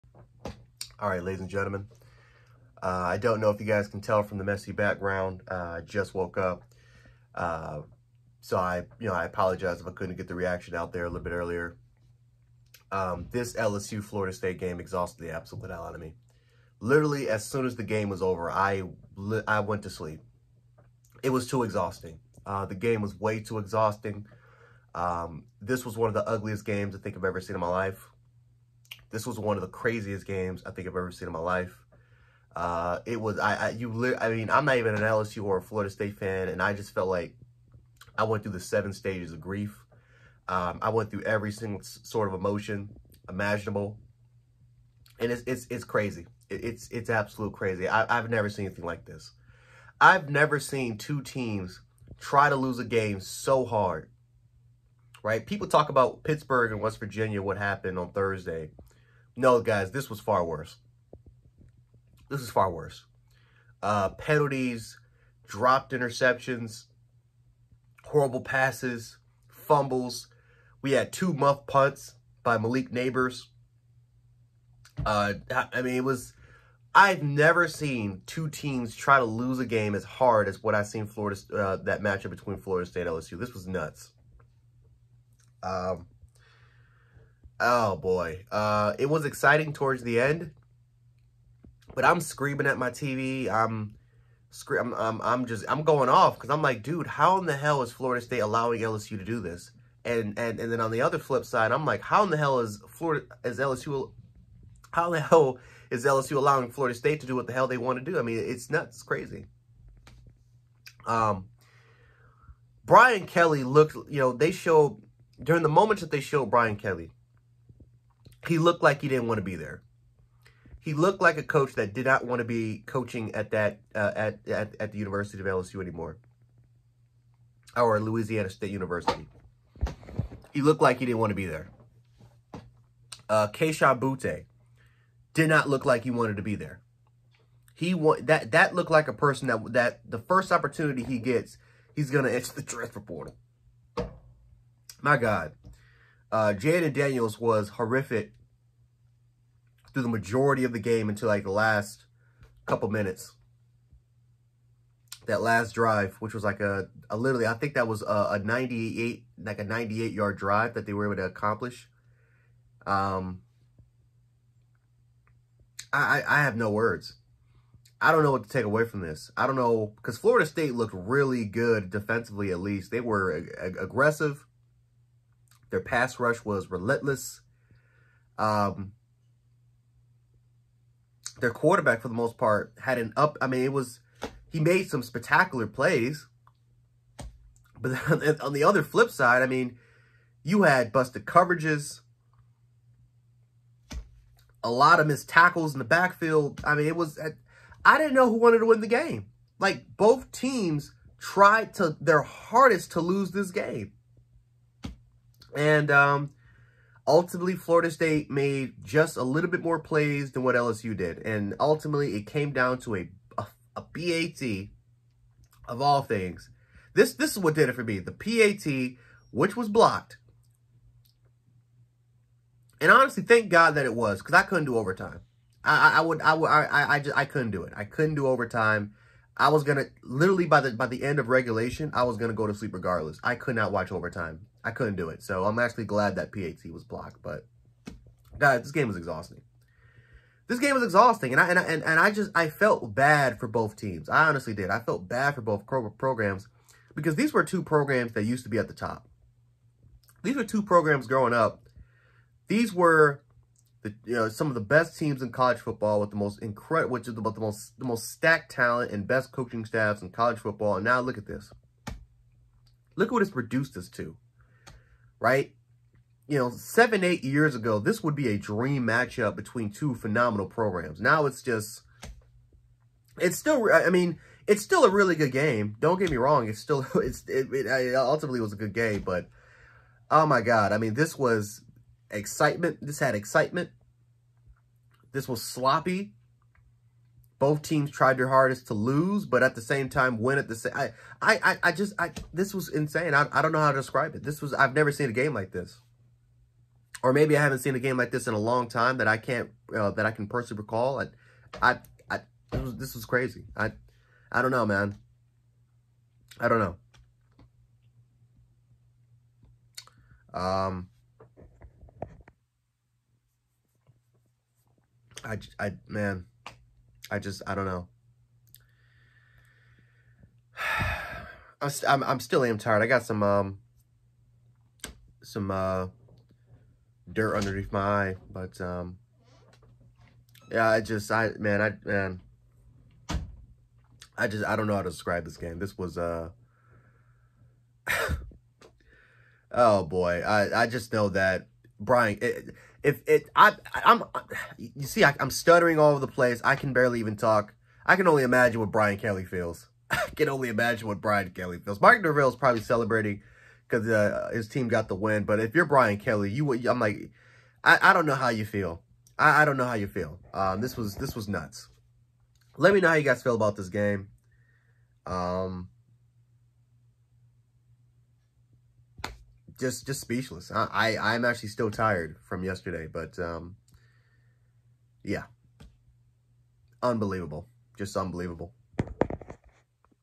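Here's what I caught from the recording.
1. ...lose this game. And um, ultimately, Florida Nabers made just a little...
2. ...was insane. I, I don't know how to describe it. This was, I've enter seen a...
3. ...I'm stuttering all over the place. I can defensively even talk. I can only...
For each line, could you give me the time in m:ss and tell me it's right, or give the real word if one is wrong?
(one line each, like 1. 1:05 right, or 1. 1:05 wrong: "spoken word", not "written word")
1. 3:22 wrong: "State", not "Nabers"
2. 4:52 wrong: "never", not "enter"
3. 5:45 wrong: "barely", not "defensively".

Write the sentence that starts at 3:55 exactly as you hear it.
So I'm actually glad that PAT was blocked.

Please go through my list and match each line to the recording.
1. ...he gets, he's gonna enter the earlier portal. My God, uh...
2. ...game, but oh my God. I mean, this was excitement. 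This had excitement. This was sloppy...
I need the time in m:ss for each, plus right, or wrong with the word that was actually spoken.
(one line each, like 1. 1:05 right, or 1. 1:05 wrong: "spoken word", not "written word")
1. 2:21 wrong: "transfer", not "earlier"
2. 4:38 right.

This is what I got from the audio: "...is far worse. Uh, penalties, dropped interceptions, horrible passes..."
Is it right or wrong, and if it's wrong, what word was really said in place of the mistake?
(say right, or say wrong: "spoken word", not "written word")
right.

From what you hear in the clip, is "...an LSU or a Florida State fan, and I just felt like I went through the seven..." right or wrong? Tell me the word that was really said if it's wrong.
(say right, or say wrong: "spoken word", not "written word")
right.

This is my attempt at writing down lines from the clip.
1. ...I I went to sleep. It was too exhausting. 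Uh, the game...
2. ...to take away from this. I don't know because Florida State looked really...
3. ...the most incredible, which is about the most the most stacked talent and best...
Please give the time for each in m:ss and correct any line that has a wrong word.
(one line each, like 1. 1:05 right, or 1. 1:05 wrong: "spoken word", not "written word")
1. 0:18 right
2. 2:48 right
3. 4:16 right.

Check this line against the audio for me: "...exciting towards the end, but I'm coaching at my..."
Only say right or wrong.
wrong.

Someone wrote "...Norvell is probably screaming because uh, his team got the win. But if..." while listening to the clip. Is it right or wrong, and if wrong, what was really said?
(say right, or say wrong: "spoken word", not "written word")
wrong: "celebrating", not "screaming".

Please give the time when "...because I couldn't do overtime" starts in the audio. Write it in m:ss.
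3:44.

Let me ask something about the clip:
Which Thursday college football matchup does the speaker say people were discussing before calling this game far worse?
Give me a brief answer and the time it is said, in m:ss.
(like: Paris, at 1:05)
Pittsburgh and West Virginia, at 0:56.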